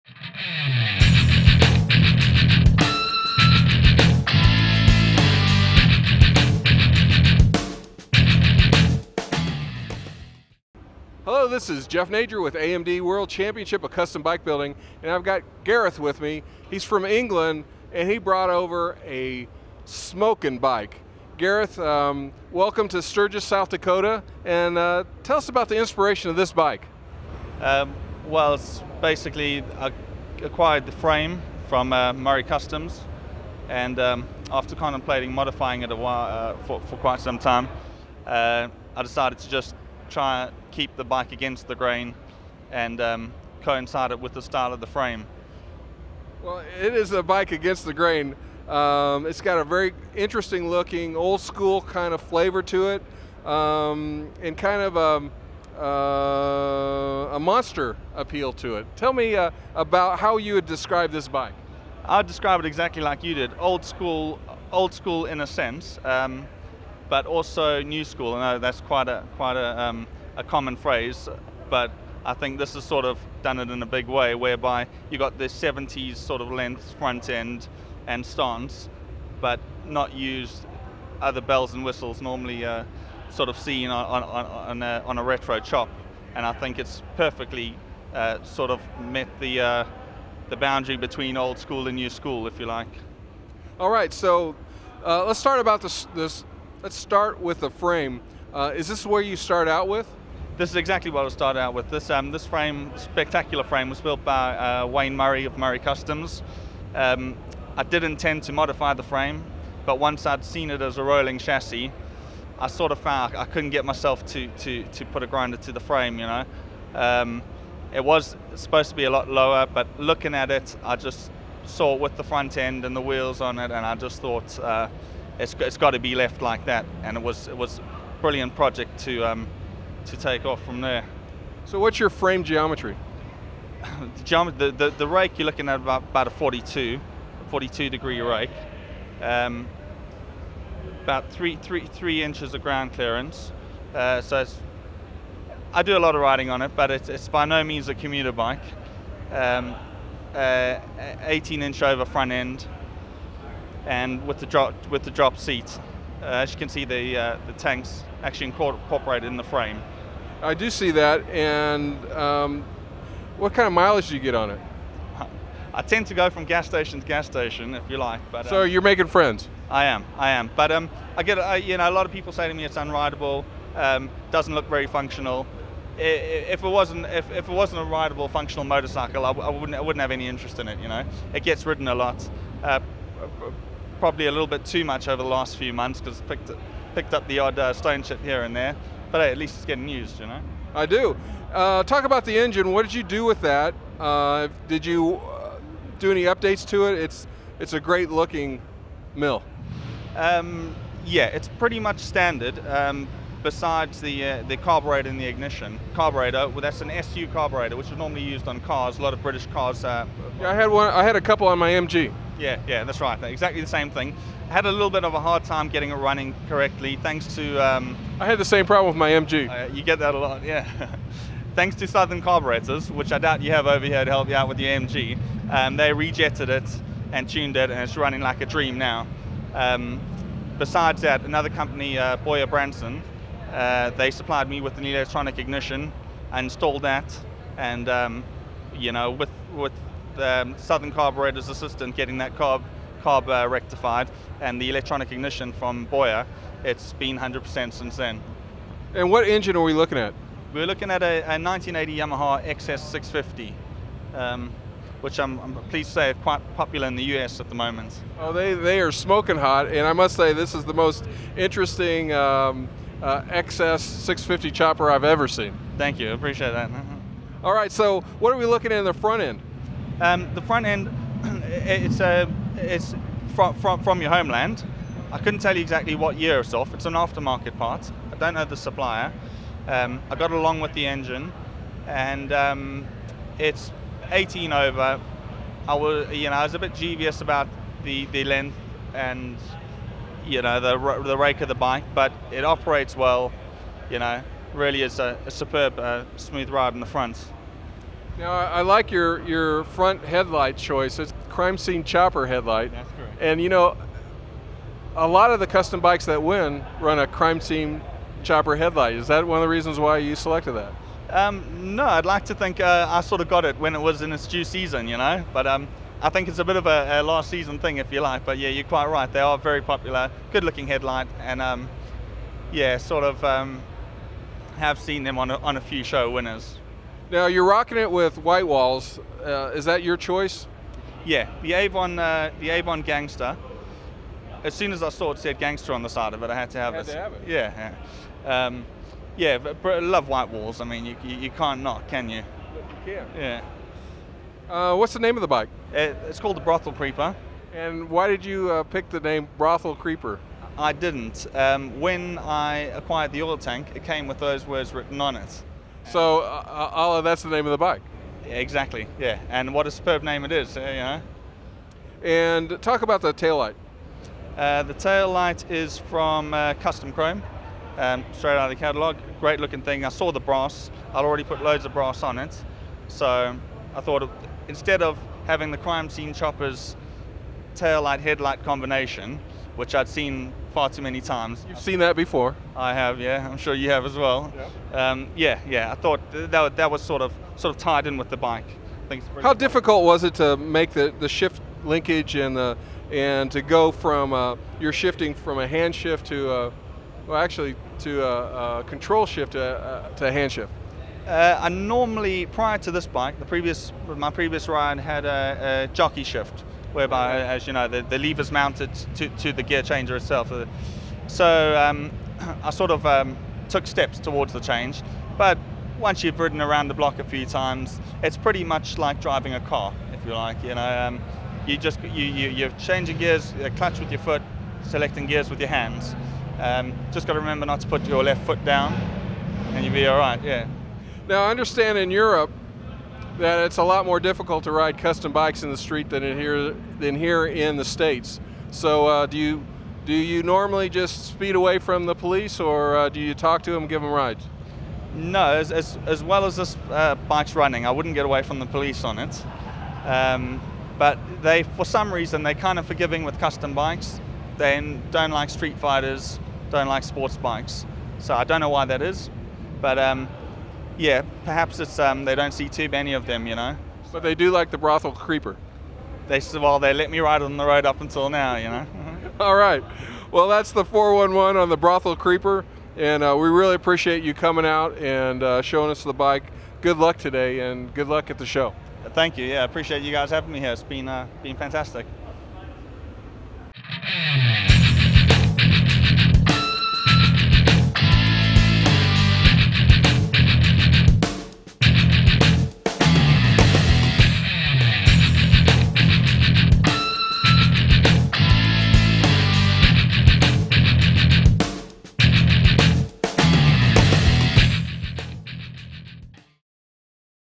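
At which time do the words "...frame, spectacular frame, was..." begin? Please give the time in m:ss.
1:42.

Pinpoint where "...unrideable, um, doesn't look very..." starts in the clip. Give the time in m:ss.
2:52.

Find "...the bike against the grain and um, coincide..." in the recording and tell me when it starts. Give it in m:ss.
0:40.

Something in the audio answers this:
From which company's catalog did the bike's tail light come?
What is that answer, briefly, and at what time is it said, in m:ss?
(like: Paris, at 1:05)
Custom Chrome, at 6:06.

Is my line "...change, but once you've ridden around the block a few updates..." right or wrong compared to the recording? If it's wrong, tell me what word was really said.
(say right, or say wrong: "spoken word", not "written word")
wrong: "times", not "updates".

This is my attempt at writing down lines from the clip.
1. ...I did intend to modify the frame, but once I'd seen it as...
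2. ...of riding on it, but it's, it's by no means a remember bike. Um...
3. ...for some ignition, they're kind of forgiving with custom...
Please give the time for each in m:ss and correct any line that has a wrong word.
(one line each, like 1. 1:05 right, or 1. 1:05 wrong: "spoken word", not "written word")
1. 1:47 right
2. 2:26 wrong: "commuter", not "remember"
3. 7:31 wrong: "reason", not "ignition".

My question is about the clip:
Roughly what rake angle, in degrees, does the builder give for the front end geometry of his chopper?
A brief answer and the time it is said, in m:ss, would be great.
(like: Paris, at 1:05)
42, at 2:17.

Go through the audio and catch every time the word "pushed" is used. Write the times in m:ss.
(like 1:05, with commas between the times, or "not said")
not said.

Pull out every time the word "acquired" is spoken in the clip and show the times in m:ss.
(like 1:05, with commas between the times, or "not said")
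0:30, 5:52.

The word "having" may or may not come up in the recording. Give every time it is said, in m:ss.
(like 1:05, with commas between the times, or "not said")
6:15, 8:00.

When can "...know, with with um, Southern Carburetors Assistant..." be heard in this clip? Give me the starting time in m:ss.
3:58.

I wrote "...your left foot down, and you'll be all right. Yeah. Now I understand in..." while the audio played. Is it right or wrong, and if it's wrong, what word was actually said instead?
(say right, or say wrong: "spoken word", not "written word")
right.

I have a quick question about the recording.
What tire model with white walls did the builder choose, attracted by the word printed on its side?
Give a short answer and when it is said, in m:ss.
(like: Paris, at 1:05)
Avon Gangster, at 5:32.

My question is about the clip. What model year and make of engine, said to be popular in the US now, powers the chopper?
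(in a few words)
1980 Yamaha.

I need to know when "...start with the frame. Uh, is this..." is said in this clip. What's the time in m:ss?
1:36.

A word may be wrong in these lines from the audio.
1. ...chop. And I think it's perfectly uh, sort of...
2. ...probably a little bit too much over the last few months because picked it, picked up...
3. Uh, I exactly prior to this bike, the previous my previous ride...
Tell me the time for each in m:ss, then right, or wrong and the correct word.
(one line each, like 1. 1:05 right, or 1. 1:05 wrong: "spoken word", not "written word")
1. 1:25 right
2. 3:04 right
3. 6:41 wrong: "normally", not "exactly".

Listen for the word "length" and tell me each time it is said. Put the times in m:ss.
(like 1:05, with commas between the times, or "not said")
1:16, 4:48.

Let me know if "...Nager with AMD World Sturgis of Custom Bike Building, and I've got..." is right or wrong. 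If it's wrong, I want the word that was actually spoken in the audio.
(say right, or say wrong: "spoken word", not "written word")
wrong: "Championship", not "Sturgis".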